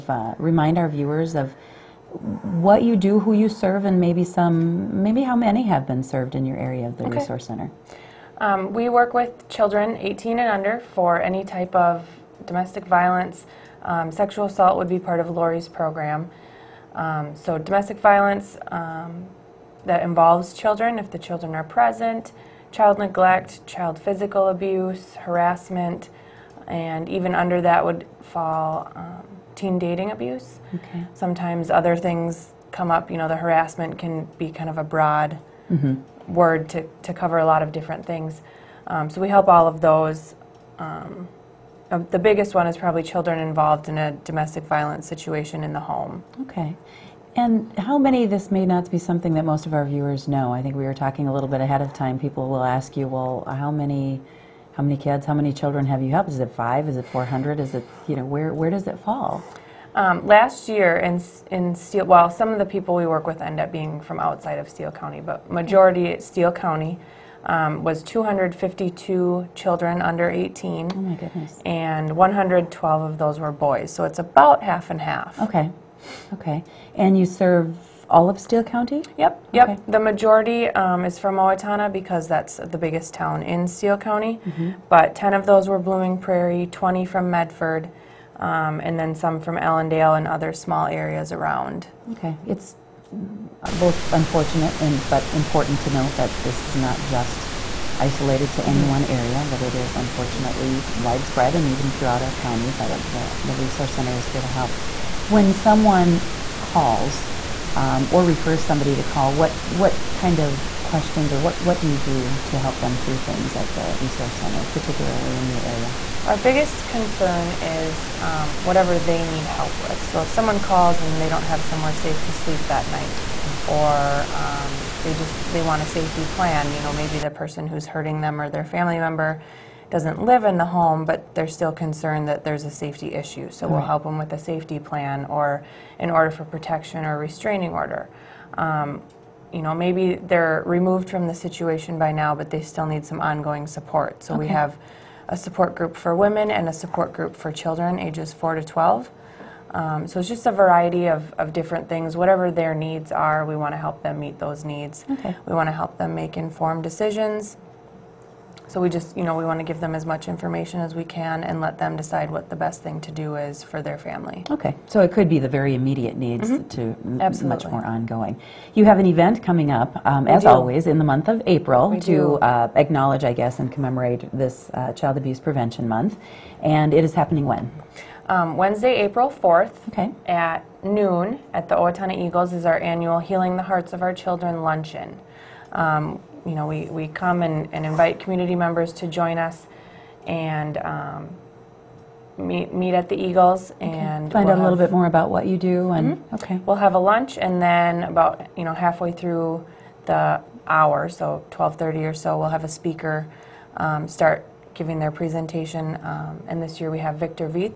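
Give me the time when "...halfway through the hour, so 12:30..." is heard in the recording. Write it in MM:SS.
03:18.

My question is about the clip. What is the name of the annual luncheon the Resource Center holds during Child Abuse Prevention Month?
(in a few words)
Healing the Hearts of Our Children.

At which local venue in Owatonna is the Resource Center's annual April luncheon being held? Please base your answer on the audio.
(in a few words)
Owatonna Eagles.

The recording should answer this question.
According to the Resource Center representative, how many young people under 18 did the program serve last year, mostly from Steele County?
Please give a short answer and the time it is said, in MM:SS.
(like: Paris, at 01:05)
252, at 01:08.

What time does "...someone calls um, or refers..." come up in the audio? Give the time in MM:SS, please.
01:45.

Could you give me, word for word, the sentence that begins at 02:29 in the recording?
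Um, so it's just a variety of, of different things.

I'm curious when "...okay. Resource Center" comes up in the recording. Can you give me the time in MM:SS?
00:07.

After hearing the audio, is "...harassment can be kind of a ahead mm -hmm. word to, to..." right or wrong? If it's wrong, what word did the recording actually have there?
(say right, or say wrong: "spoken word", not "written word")
wrong: "broad", not "ahead".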